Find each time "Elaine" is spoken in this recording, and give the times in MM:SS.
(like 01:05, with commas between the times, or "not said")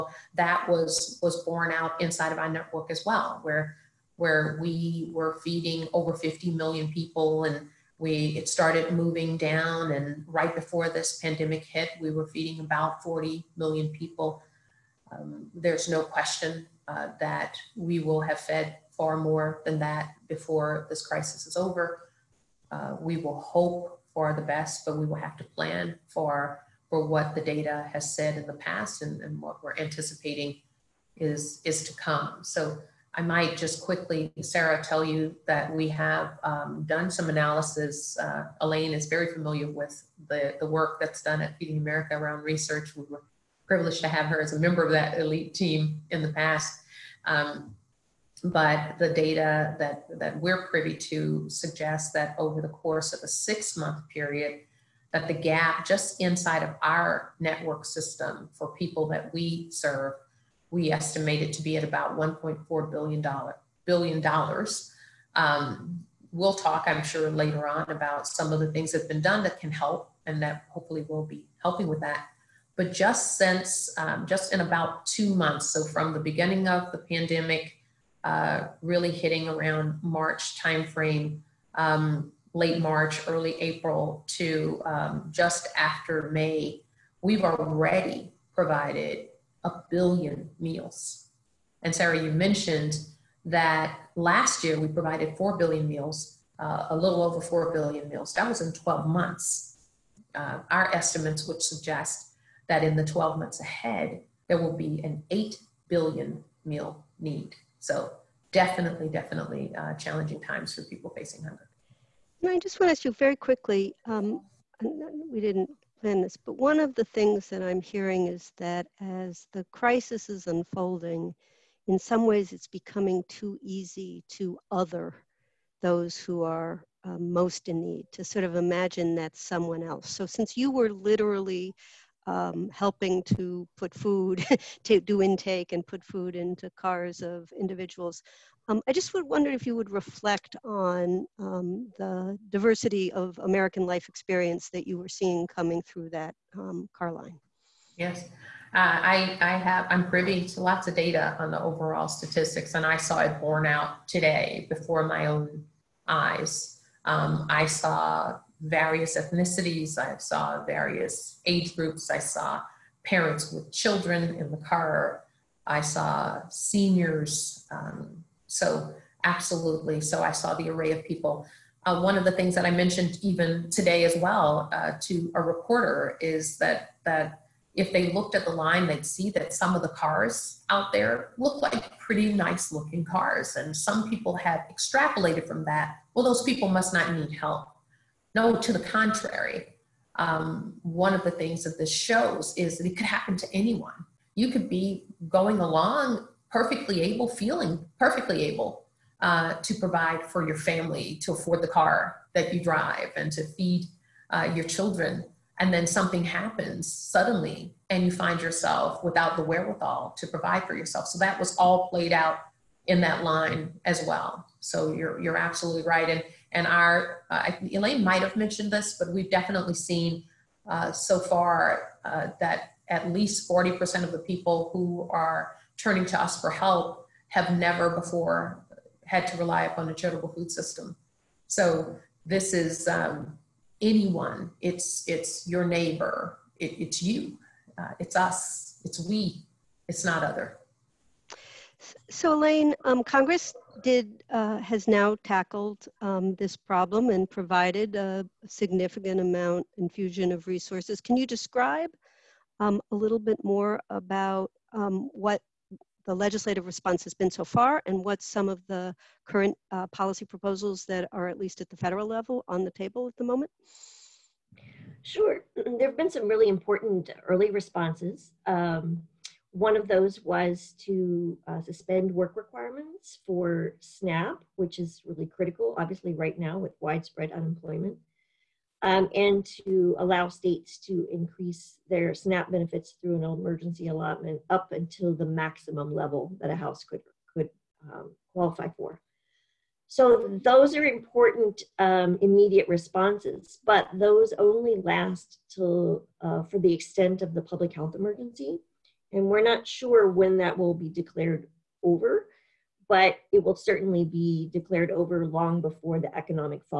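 00:38, 03:37, 04:02.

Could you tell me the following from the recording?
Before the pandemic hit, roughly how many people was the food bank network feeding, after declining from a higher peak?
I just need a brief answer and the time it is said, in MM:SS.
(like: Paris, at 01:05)
40 million, at 00:13.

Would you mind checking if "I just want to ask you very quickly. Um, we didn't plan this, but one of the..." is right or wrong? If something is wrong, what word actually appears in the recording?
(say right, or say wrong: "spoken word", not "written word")
right.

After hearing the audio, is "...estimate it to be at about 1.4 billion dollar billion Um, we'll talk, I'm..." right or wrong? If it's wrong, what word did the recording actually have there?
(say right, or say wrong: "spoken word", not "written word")
right.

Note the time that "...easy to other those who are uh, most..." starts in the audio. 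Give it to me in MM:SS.
02:03.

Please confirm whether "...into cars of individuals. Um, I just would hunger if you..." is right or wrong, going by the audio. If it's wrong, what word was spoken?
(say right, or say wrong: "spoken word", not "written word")
wrong: "wonder", not "hunger".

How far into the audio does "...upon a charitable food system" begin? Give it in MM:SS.
03:49.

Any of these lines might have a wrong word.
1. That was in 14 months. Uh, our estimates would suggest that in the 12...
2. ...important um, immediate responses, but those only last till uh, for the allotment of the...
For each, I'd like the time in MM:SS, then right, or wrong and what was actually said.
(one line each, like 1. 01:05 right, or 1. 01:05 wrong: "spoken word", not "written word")
1. 01:38 wrong: "12", not "14"
2. 04:50 wrong: "extent", not "allotment".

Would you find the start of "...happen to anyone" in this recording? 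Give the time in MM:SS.
03:13.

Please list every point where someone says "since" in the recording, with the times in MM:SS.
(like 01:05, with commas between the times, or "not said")
01:13, 02:10.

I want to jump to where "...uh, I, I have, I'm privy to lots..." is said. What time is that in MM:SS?
02:28.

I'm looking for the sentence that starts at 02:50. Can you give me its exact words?
So I saw the array of people.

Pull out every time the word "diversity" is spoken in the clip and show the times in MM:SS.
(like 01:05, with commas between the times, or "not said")
02:22.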